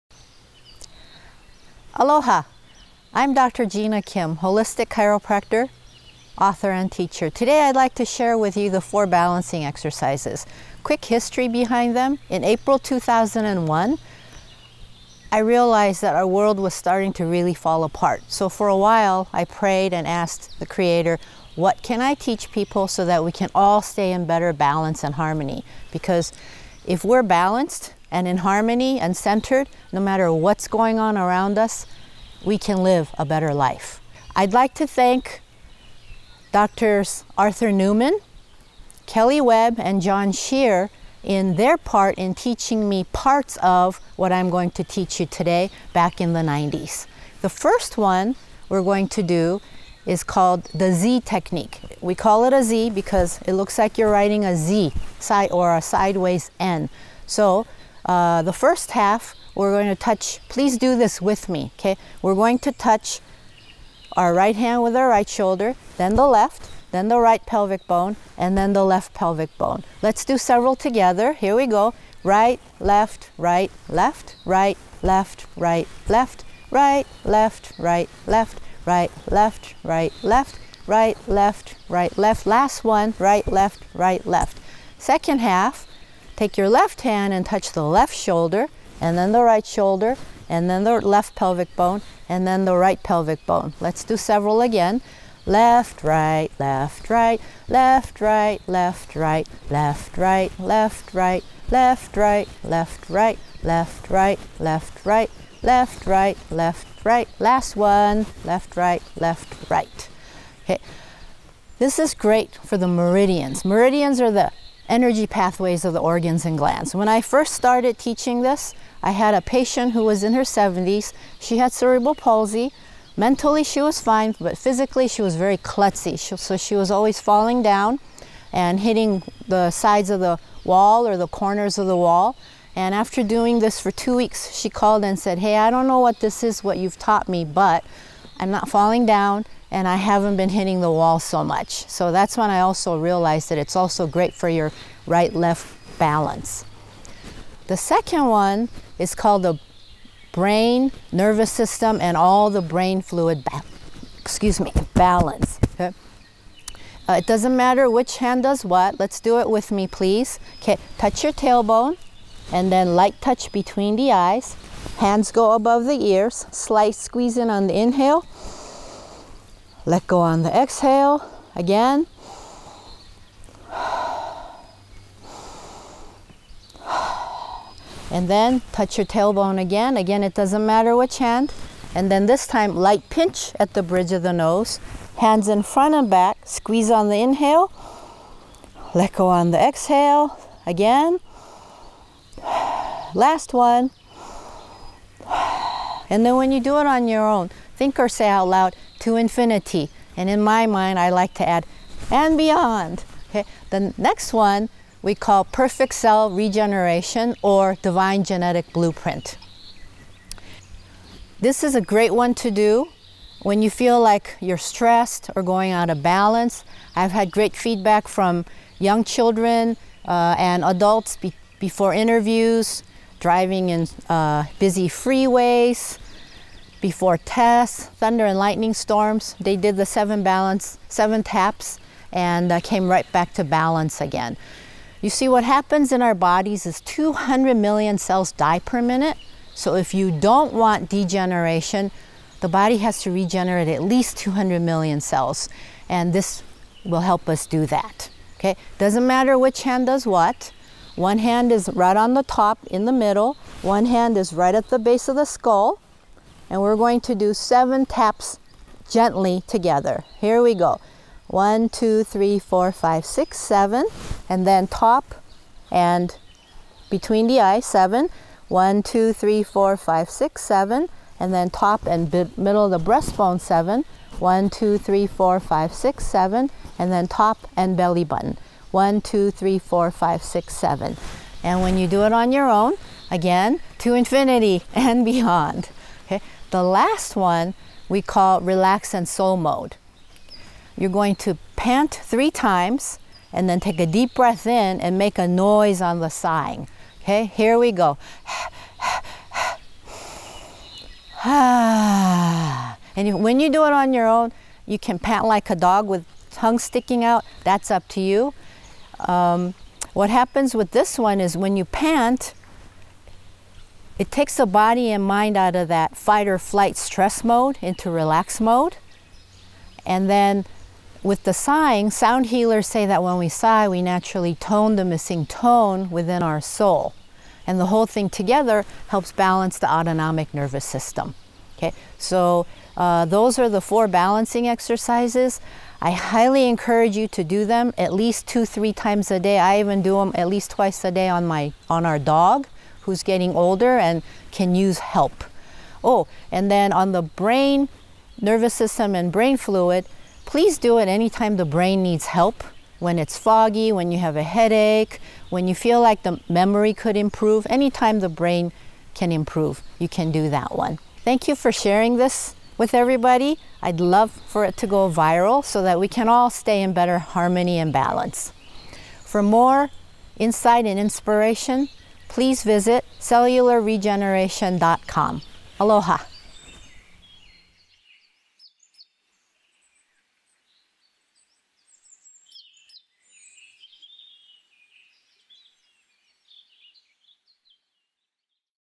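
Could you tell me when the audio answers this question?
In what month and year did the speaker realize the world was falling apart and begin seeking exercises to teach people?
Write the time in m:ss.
0:12.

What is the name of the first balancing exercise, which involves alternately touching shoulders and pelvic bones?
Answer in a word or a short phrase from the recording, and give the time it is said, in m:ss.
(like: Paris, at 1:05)
Z technique, at 0:50.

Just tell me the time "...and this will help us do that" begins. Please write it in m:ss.
4:05.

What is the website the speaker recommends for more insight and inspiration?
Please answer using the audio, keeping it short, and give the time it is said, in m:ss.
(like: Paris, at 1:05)
cellularregeneration.com, at 6:12.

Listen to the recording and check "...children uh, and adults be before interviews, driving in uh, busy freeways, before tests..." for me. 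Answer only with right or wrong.
right.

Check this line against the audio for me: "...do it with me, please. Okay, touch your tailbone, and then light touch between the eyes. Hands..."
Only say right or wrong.
right.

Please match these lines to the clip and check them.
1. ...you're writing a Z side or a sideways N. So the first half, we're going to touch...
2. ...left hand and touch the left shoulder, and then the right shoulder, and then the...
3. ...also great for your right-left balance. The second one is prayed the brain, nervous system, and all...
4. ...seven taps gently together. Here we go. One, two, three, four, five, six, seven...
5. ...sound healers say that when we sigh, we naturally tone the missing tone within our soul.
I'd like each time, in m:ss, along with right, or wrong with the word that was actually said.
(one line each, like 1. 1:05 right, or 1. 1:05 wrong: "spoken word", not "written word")
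1. 0:53 right
2. 1:26 right
3. 2:23 wrong: "called", not "prayed"
4. 4:17 right
5. 5:21 right.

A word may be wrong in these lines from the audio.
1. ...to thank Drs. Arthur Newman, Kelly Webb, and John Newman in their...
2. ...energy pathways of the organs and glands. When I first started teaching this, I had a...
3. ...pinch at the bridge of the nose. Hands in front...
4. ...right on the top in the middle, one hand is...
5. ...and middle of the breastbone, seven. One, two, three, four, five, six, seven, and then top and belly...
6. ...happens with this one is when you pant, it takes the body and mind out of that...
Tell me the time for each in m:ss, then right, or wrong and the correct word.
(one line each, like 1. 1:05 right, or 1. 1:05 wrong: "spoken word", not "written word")
1. 0:34 wrong: "Shear", not "Newman"
2. 1:54 right
3. 3:03 right
4. 4:11 right
5. 4:31 right
6. 5:10 right.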